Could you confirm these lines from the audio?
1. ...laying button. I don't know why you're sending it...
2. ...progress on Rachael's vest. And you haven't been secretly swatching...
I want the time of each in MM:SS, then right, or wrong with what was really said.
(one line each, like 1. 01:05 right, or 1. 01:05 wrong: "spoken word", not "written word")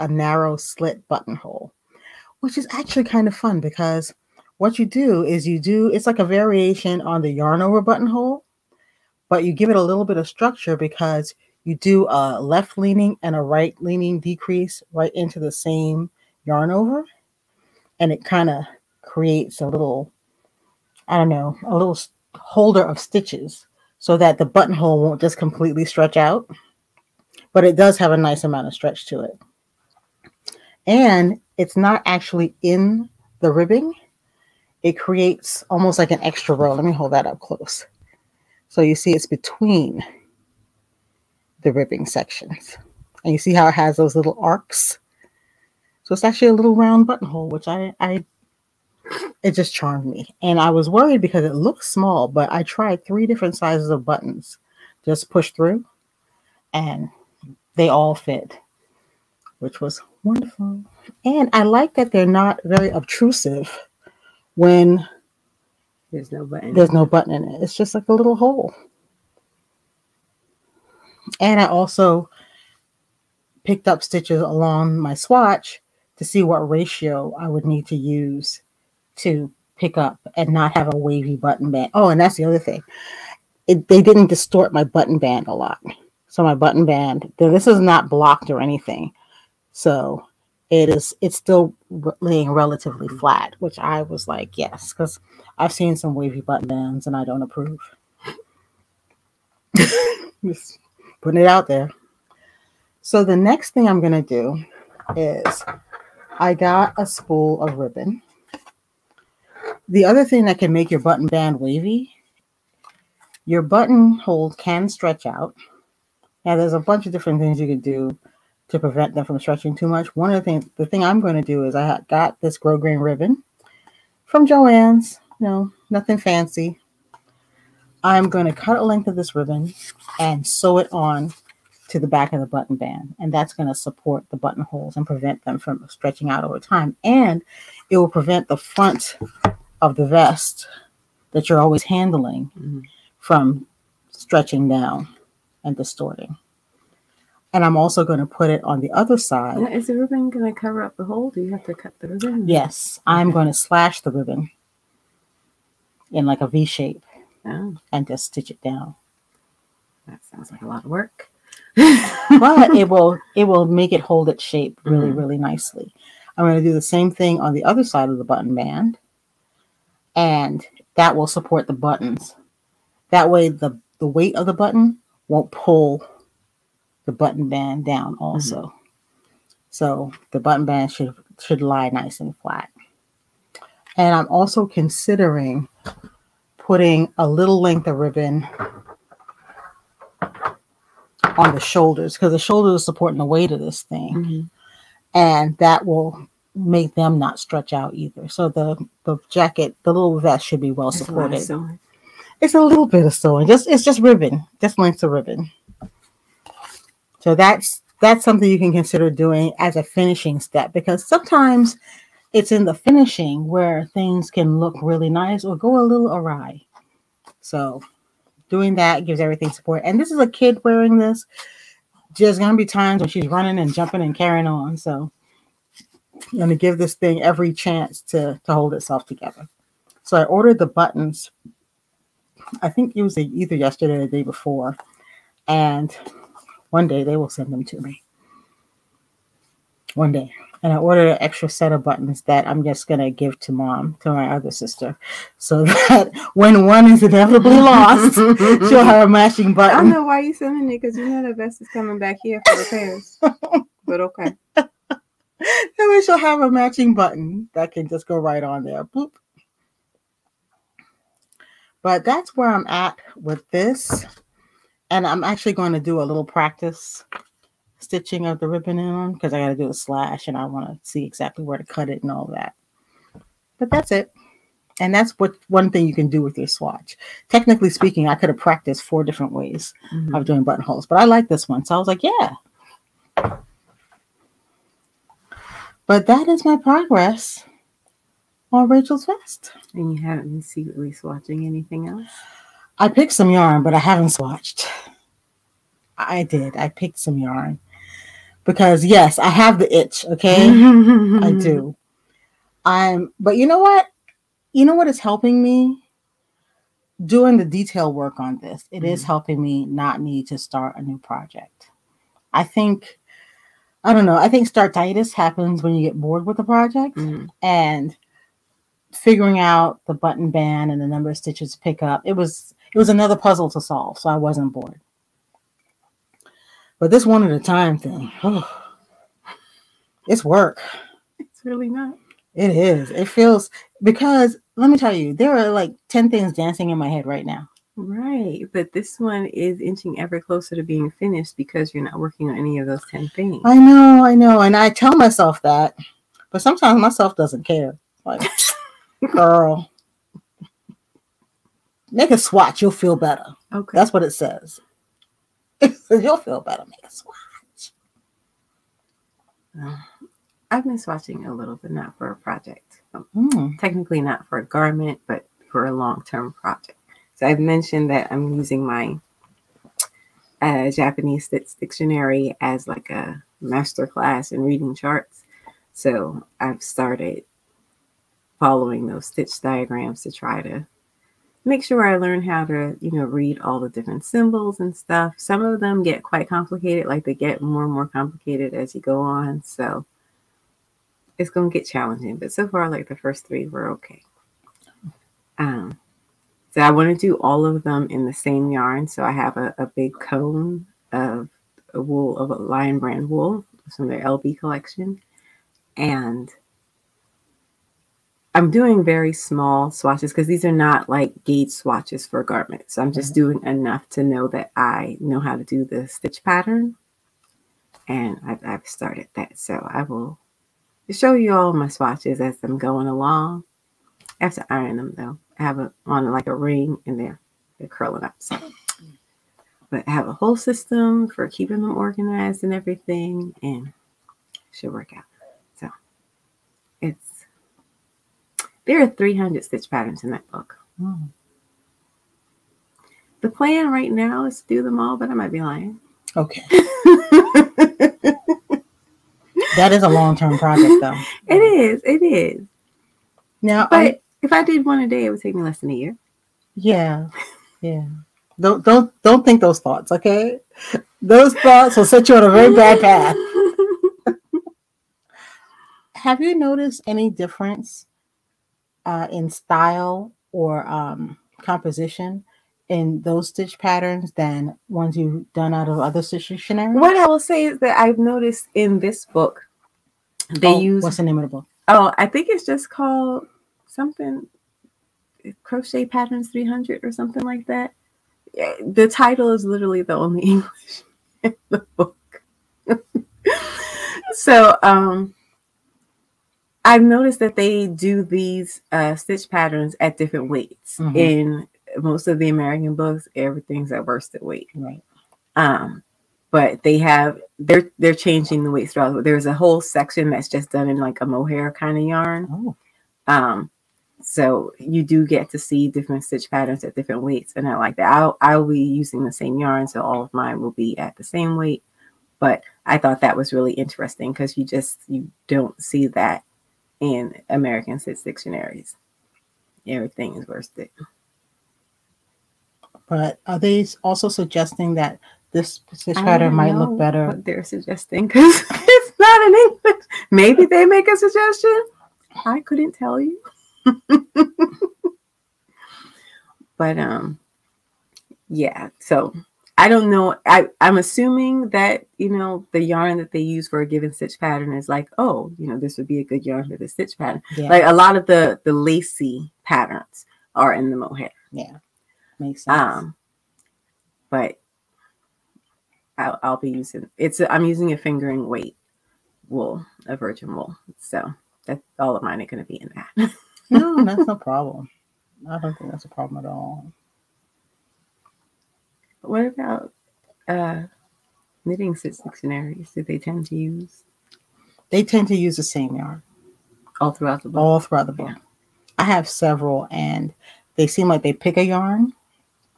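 1. 04:09 wrong: "matching", not "laying"
2. 04:46 right.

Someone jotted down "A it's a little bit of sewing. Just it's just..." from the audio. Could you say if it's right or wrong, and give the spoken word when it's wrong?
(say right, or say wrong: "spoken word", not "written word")
right.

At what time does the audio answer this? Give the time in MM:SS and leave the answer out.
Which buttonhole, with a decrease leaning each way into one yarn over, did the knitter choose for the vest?
00:00.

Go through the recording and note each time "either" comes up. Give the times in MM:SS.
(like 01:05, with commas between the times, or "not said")
03:17, 03:53.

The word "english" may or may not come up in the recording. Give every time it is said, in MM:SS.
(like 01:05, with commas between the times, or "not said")
08:10, 08:59.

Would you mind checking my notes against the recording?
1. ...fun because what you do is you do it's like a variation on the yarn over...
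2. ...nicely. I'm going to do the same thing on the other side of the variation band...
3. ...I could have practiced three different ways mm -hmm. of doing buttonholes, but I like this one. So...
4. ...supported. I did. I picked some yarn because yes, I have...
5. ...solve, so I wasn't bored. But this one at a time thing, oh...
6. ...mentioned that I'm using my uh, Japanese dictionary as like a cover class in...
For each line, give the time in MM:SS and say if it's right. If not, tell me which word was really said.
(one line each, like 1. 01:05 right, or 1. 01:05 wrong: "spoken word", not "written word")
1. 00:03 right
2. 02:45 wrong: "button", not "variation"
3. 04:38 wrong: "four", not "three"
4. 04:54 wrong: "swatched", not "supported"
5. 05:23 right
6. 06:07 wrong: "master", not "cover".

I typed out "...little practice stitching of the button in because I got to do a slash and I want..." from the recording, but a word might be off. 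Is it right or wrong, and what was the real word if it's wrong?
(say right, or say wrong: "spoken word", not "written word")
wrong: "ribbon", not "button".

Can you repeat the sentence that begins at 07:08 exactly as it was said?
So, but I have a whole system for keeping them organized and everything, and should work out.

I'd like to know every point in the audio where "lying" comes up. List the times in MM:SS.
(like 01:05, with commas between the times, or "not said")
07:25.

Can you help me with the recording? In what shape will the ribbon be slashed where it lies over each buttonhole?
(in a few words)
V shape.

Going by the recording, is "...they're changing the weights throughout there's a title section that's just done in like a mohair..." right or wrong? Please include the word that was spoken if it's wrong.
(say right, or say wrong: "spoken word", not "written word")
wrong: "whole", not "title".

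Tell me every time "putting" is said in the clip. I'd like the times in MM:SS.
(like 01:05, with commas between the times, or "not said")
01:41, 03:06.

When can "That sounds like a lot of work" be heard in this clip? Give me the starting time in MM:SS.
02:40.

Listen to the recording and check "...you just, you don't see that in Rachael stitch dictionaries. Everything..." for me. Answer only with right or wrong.
wrong.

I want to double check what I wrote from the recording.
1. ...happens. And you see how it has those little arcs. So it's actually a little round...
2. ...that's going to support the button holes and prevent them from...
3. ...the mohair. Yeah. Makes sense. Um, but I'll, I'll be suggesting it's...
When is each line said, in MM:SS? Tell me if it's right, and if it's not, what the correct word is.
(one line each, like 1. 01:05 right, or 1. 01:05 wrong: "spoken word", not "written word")
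1. 00:42 wrong: "sections", not "happens"
2. 02:13 right
3. 09:20 wrong: "using", not "suggesting".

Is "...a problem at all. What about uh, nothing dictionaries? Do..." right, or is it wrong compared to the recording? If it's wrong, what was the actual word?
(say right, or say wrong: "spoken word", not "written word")
wrong: "knitting", not "nothing".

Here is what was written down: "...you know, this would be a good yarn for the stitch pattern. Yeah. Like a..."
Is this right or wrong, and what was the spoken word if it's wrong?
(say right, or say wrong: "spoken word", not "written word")
right.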